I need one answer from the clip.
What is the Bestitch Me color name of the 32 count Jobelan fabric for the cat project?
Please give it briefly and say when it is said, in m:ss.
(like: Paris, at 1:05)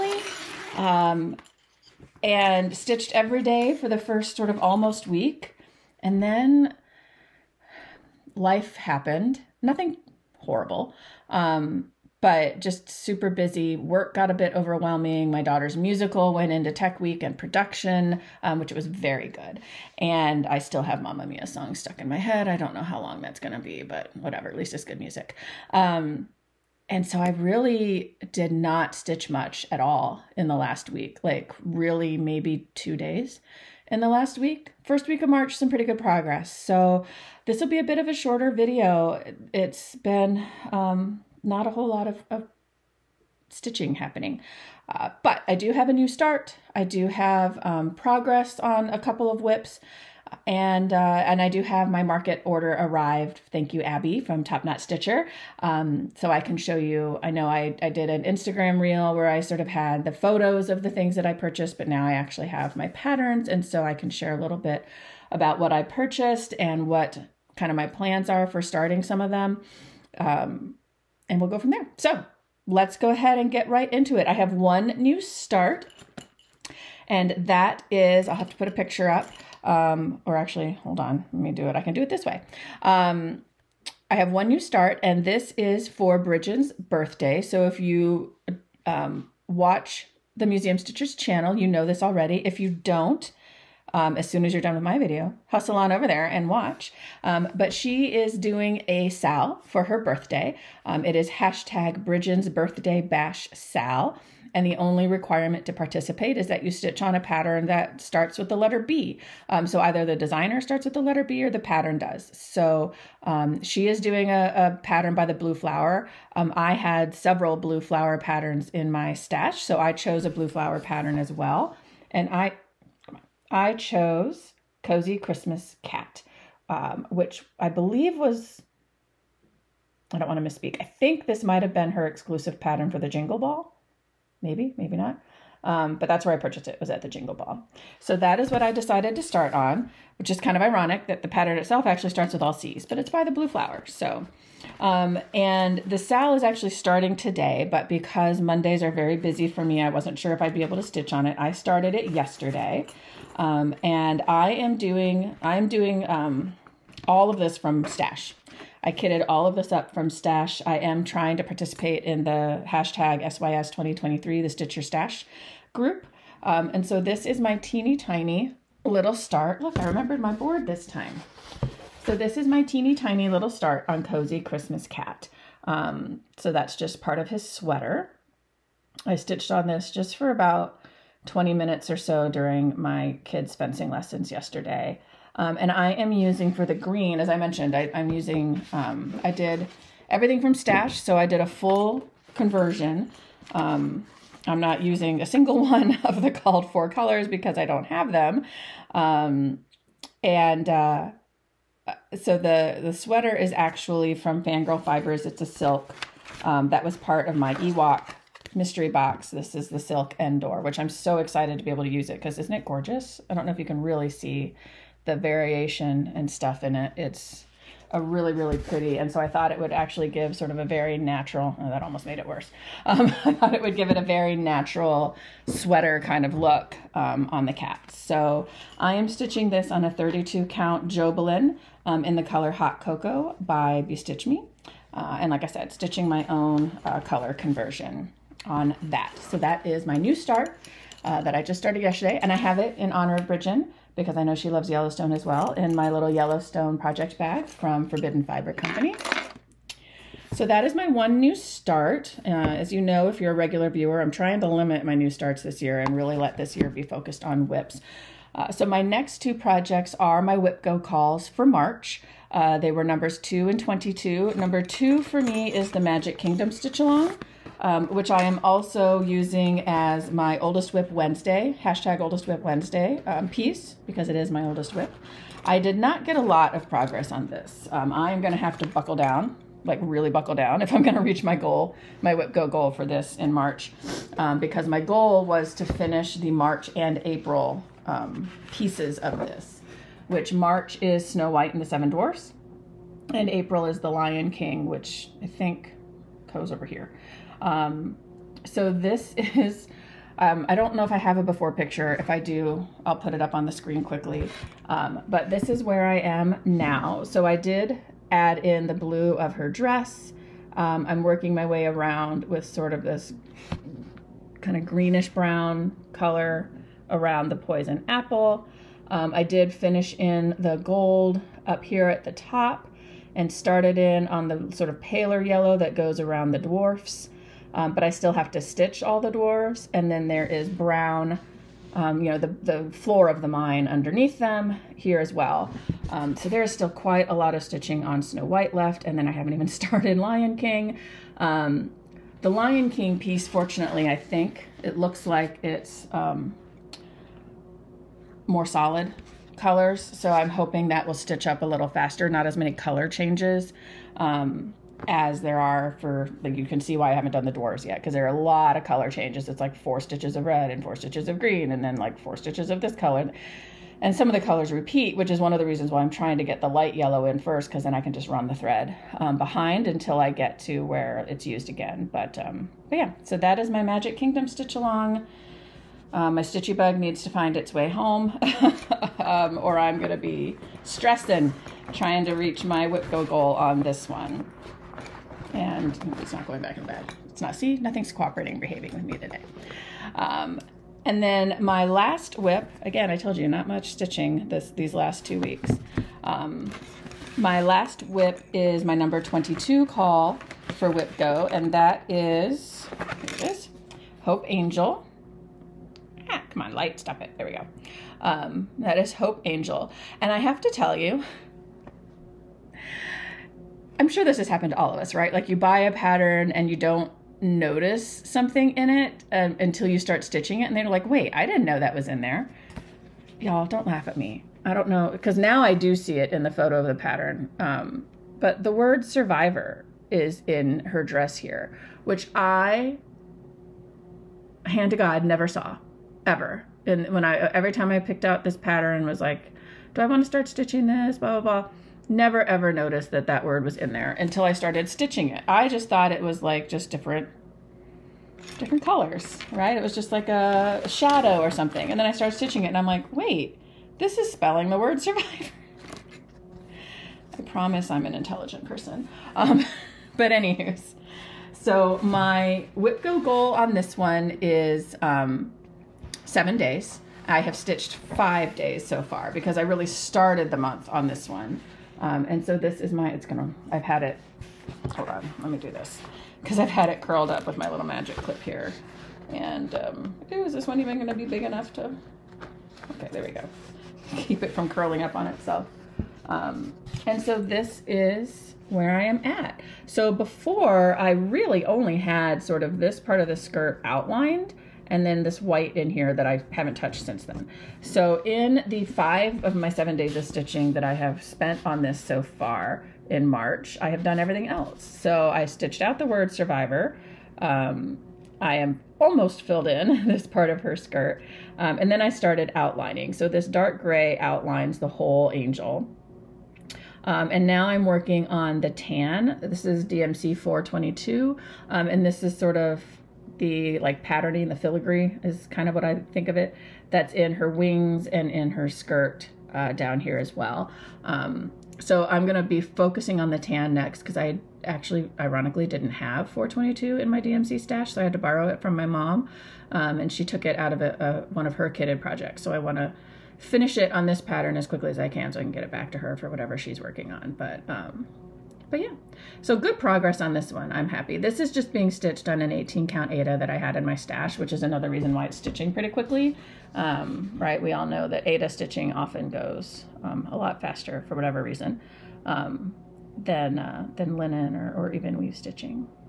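Hot cocoa, at 3:52.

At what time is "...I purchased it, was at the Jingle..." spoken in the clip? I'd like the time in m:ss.
2:16.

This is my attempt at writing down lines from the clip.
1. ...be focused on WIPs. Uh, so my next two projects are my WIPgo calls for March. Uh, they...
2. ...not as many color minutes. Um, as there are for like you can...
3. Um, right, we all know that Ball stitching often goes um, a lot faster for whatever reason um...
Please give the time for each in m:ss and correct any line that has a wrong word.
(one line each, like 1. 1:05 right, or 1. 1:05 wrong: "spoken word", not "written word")
1. 4:16 right
2. 5:52 wrong: "changes", not "minutes"
3. 9:16 wrong: "Aida", not "Ball".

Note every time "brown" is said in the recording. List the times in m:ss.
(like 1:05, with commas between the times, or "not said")
5:15, 5:30.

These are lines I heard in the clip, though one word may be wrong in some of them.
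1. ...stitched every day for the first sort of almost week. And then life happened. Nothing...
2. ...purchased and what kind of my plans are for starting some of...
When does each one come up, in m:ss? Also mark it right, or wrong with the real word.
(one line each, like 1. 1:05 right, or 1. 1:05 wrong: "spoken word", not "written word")
1. 0:02 right
2. 1:05 right.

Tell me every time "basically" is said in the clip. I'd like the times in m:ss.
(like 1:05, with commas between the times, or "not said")
not said.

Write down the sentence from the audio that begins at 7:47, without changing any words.
I have stitched five days so far because I really started the month on this one.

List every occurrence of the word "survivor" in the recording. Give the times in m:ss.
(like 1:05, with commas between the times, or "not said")
7:08, 7:34, 8:26.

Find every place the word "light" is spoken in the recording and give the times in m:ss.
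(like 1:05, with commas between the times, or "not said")
6:06, 6:46.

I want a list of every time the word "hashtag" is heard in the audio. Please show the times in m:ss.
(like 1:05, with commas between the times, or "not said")
1:41, 2:42, 4:31.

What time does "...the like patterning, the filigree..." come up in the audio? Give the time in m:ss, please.
8:43.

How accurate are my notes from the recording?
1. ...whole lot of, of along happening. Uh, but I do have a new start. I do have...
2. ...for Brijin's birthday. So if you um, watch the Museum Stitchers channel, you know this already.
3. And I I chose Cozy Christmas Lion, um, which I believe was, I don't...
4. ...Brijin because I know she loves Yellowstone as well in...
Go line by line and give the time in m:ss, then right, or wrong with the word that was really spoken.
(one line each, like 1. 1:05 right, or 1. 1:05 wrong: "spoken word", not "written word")
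1. 0:41 wrong: "stitching", not "along"
2. 1:25 right
3. 2:02 wrong: "Cat", not "Lion"
4. 4:03 right.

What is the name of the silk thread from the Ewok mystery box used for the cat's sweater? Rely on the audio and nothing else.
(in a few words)
Endor.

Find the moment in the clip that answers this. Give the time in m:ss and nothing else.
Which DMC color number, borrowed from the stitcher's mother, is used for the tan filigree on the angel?
8:39.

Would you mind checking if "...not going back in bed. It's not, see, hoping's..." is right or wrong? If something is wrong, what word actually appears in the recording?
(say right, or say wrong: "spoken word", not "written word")
wrong: "nothing", not "hoping".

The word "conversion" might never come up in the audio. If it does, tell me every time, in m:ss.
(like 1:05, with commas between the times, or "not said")
3:12, 3:57.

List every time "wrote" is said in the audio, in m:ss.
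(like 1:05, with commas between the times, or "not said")
not said.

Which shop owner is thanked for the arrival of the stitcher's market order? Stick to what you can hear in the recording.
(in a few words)
Abby.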